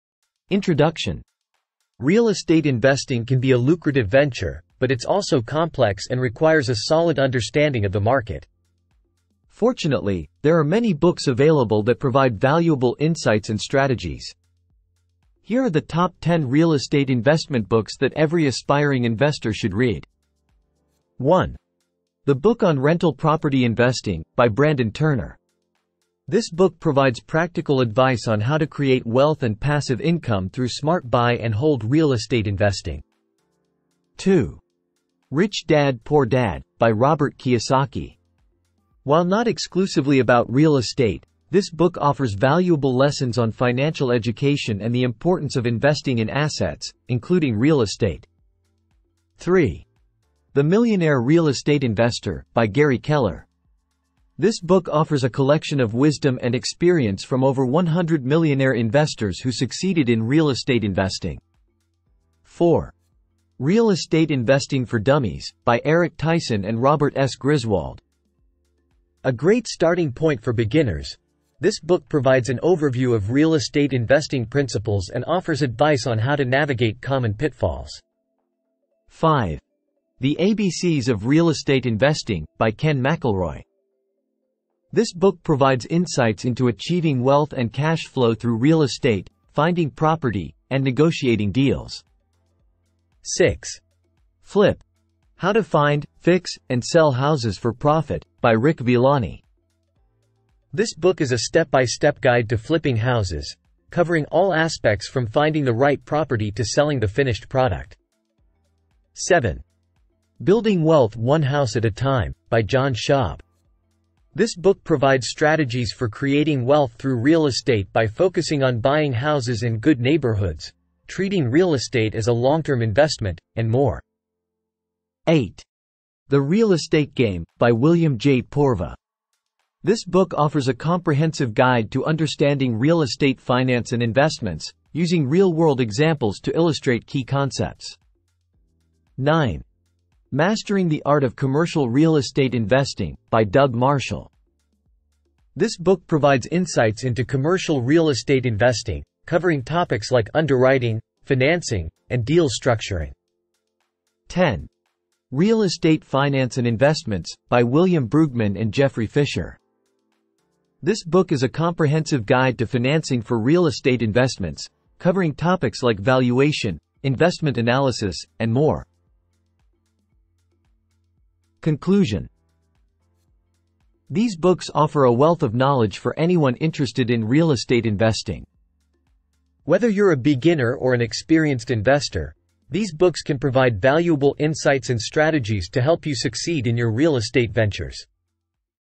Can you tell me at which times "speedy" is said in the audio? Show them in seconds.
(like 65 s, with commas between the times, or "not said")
not said.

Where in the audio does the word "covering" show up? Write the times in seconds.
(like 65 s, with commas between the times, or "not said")
103 s, 149 s, 164 s.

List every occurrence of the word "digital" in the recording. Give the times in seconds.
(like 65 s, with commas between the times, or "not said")
not said.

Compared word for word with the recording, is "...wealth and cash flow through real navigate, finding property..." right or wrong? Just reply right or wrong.
wrong.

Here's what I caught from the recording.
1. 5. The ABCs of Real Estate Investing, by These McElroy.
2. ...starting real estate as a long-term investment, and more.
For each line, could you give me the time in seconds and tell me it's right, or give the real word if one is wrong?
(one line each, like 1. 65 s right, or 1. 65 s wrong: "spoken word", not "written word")
1. 79 s wrong: "Ken", not "These"
2. 121 s wrong: "treating", not "starting".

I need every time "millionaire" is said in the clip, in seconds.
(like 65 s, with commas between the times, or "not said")
50 s, 58 s.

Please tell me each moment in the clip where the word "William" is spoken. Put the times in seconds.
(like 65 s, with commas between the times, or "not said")
127 s, 157 s.